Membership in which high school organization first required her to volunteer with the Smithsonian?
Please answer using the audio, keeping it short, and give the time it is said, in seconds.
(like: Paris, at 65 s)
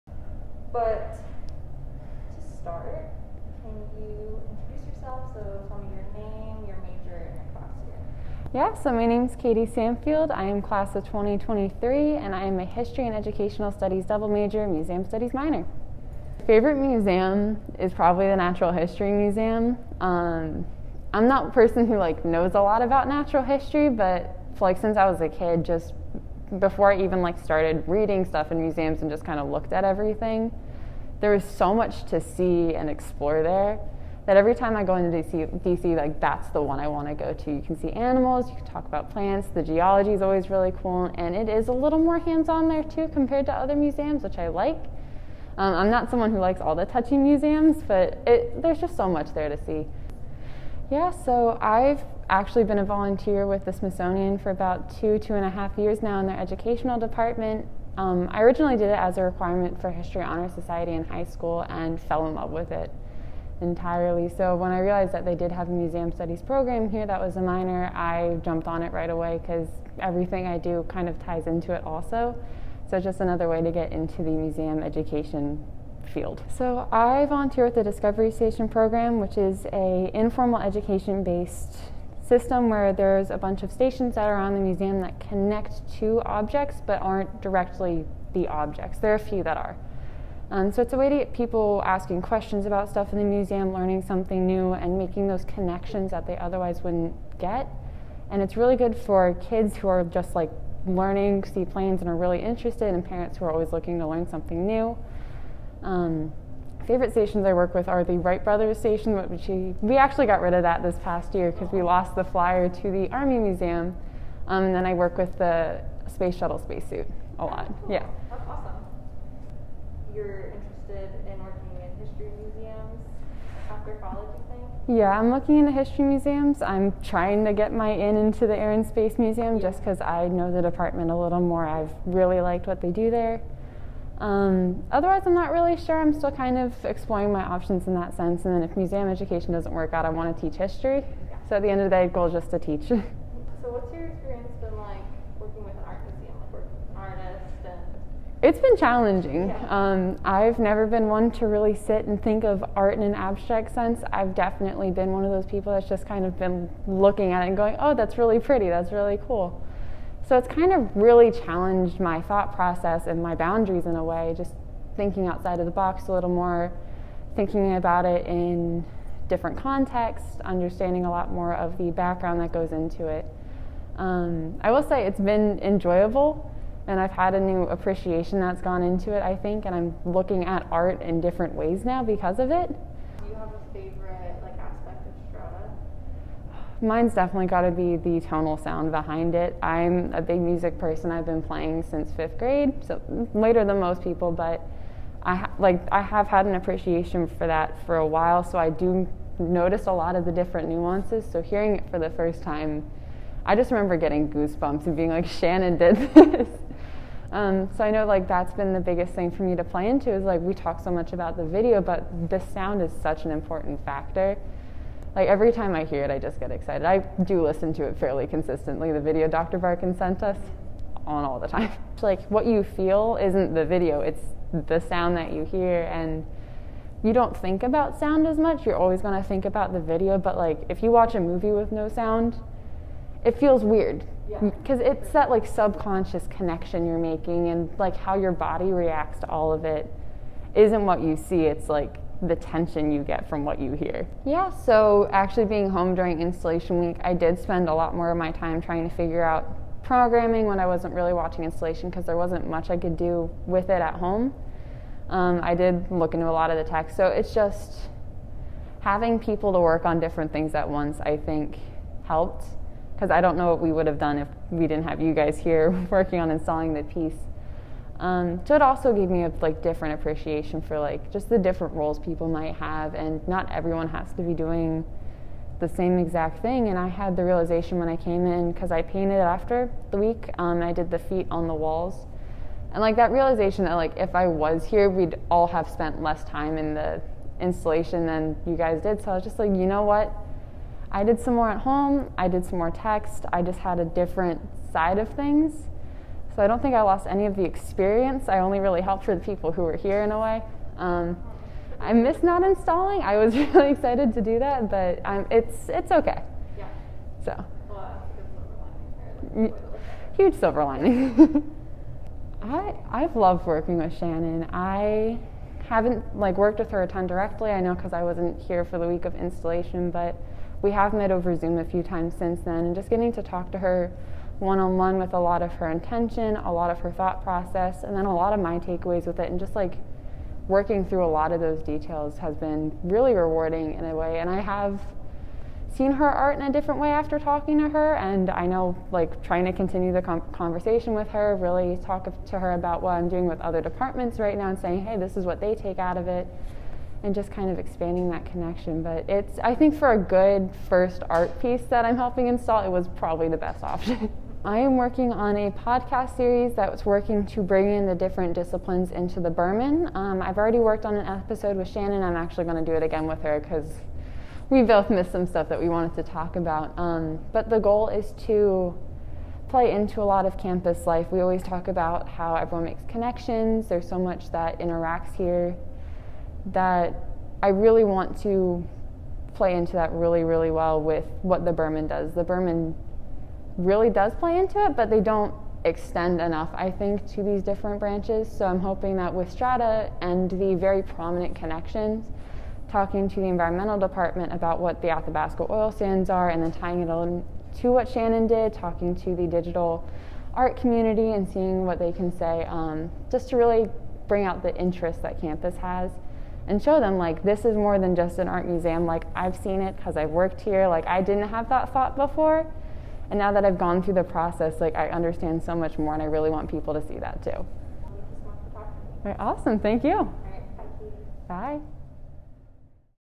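History Honor Society, at 59 s.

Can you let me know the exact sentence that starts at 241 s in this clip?
It's like the tension you get from what you hear.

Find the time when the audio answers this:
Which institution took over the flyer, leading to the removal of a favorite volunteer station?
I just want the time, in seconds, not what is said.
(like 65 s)
113 s.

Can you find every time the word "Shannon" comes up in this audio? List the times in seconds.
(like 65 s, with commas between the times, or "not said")
205 s, 313 s, 361 s, 397 s.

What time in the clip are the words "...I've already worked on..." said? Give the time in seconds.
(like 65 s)
360 s.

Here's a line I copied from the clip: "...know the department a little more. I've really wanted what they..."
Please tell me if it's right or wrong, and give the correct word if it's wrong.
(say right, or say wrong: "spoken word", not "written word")
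wrong: "liked", not "wanted".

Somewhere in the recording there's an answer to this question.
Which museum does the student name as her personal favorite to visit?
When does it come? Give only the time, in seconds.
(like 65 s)
18 s.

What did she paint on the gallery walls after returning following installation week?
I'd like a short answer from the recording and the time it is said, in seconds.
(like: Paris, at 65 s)
the feet, at 280 s.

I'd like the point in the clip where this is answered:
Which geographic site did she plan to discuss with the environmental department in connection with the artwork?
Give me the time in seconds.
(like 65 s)
394 s.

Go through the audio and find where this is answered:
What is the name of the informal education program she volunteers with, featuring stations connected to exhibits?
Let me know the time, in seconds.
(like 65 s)
77 s.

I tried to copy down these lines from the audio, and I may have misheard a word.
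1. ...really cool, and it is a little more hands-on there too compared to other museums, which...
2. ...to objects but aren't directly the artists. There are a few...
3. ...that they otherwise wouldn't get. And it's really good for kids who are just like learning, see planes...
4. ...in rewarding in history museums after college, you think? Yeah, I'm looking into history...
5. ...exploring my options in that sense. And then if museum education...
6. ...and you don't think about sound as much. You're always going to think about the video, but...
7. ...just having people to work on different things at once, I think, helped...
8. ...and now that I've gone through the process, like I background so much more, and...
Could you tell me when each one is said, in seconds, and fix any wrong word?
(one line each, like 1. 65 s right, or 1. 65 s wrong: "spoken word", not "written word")
1. 40 s right
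2. 85 s wrong: "objects", not "artists"
3. 96 s right
4. 121 s wrong: "working", not "rewarding"
5. 136 s right
6. 225 s right
7. 257 s right
8. 413 s wrong: "understand", not "background".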